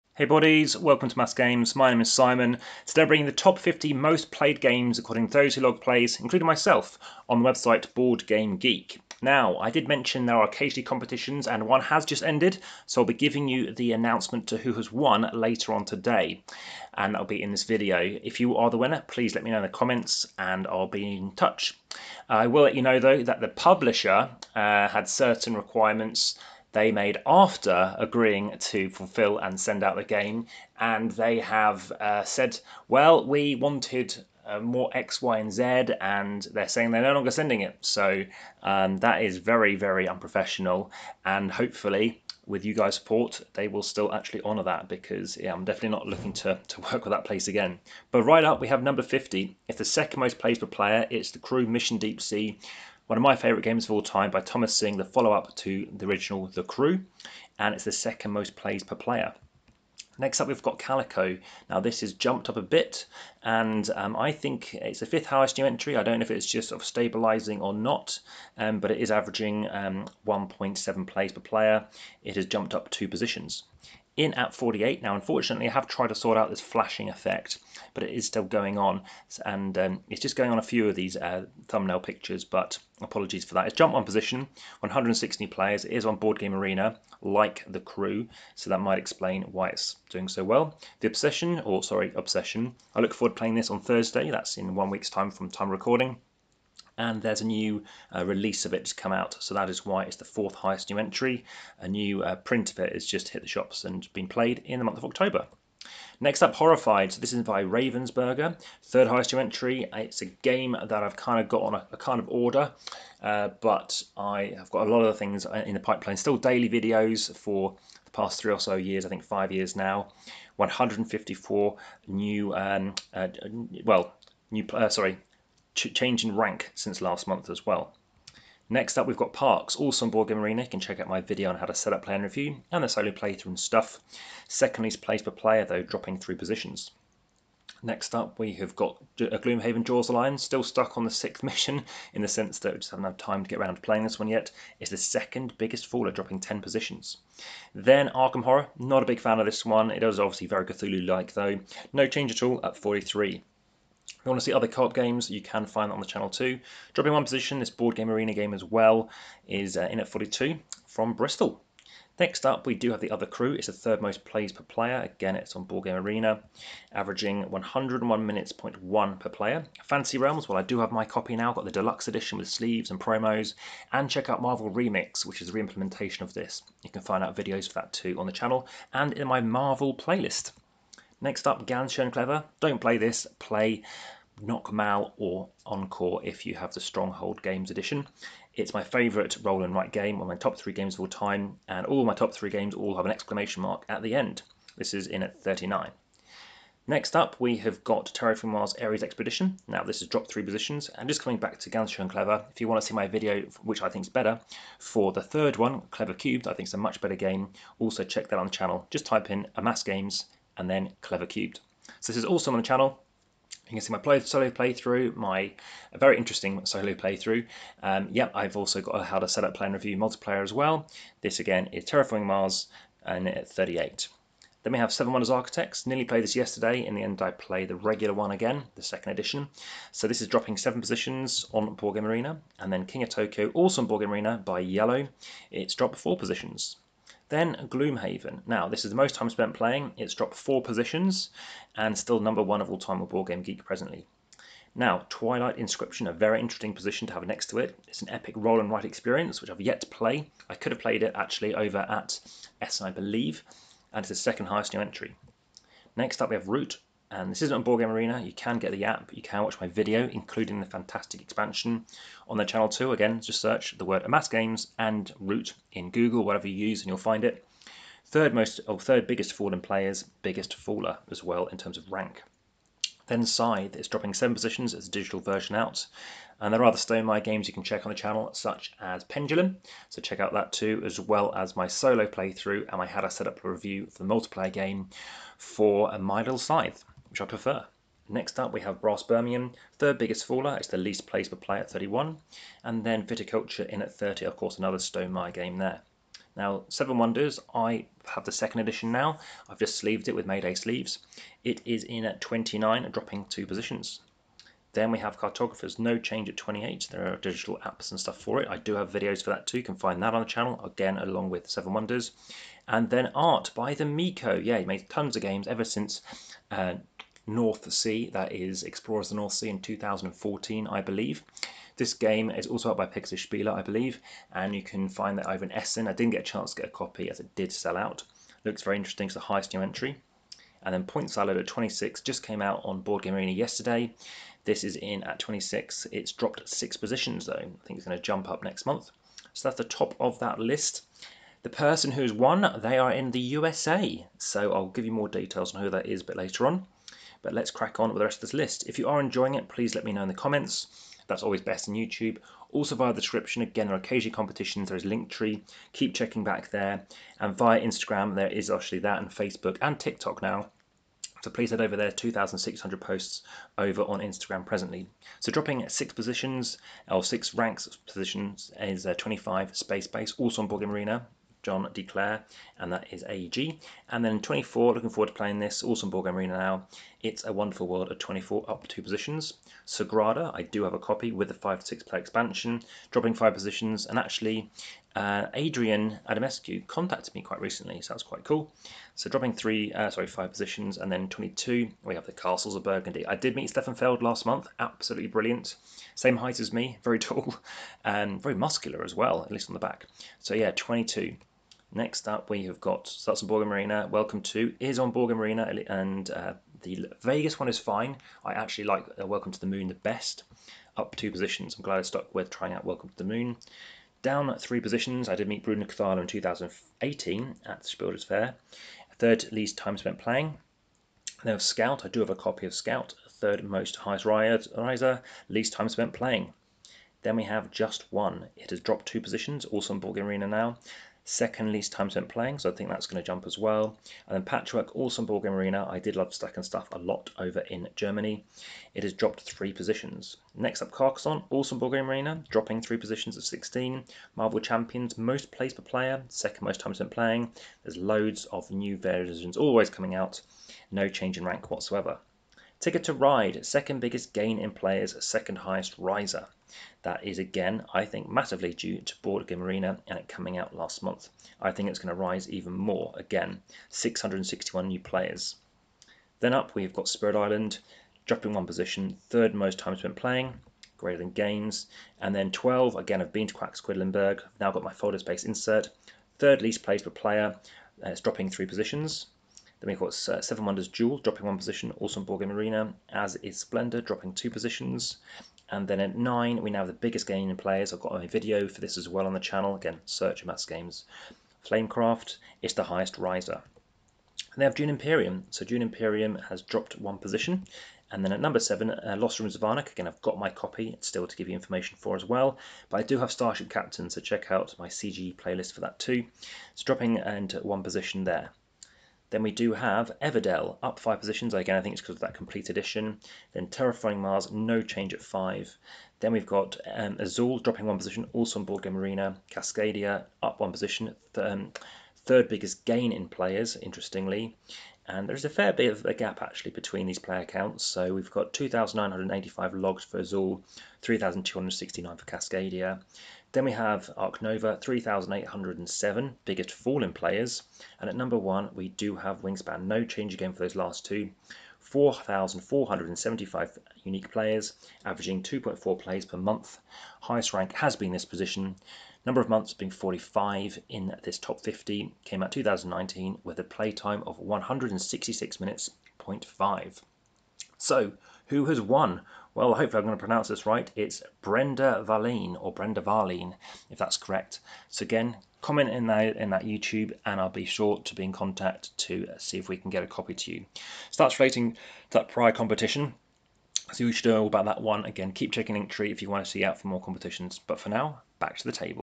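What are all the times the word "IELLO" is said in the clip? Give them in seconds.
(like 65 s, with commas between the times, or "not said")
234 s.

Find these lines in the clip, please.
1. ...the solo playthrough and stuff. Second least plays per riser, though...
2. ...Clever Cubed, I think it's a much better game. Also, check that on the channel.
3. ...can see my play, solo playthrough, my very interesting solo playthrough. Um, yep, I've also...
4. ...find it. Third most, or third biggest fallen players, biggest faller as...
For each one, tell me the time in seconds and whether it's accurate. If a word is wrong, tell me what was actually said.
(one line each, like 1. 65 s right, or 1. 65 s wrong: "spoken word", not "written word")
1. 132 s wrong: "player", not "riser"
2. 205 s right
3. 213 s right
4. 266 s right.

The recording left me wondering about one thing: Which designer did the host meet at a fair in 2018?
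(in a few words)
Bruno Cathala.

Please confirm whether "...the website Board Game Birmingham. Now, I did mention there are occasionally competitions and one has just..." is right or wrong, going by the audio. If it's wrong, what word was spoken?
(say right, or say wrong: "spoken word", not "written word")
wrong: "Geek", not "Birmingham".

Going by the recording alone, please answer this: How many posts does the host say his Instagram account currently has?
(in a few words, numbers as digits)
2,600.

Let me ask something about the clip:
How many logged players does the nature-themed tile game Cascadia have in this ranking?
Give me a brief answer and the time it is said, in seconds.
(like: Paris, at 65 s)
3,269, at 530 s.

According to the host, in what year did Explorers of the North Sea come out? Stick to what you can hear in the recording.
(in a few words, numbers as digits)
2014.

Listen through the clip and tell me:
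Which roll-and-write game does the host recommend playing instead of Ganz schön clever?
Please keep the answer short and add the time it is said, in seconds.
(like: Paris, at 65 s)
Noch mal, at 184 s.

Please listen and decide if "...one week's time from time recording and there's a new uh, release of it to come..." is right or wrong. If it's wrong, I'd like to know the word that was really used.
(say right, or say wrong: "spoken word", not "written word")
right.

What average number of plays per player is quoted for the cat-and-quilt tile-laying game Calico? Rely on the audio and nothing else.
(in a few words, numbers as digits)
1.7.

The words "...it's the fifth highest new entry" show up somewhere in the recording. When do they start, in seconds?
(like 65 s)
64 s.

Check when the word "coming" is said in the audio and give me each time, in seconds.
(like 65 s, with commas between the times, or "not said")
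201 s, 449 s, 460 s.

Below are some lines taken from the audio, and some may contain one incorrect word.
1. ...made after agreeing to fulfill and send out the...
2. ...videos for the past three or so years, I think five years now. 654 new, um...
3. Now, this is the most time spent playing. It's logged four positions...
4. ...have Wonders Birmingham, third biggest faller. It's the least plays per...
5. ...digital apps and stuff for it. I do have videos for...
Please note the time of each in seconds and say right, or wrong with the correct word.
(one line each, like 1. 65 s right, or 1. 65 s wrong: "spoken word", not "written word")
1. 26 s right
2. 116 s wrong: "154", not "654"
3. 238 s wrong: "dropped", not "logged"
4. 288 s wrong: "Brass", not "Wonders"
5. 307 s right.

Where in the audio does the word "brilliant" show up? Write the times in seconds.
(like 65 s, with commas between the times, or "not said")
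395 s.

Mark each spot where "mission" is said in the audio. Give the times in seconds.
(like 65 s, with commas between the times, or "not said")
51 s, 141 s.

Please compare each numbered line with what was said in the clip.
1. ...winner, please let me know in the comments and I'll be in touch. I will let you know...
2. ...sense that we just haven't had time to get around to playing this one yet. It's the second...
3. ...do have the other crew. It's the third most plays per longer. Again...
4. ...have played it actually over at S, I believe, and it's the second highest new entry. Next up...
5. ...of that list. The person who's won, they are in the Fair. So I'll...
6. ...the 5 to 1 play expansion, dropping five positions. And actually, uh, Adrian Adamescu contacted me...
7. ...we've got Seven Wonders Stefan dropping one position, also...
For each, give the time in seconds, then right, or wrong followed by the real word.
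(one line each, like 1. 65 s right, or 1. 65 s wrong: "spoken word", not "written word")
1. 18 s right
2. 142 s right
3. 162 s wrong: "player", not "longer"
4. 250 s right
5. 339 s wrong: "USA", not "Fair"
6. 381 s wrong: "6", not "1"
7. 479 s wrong: "Duel", not "Stefan".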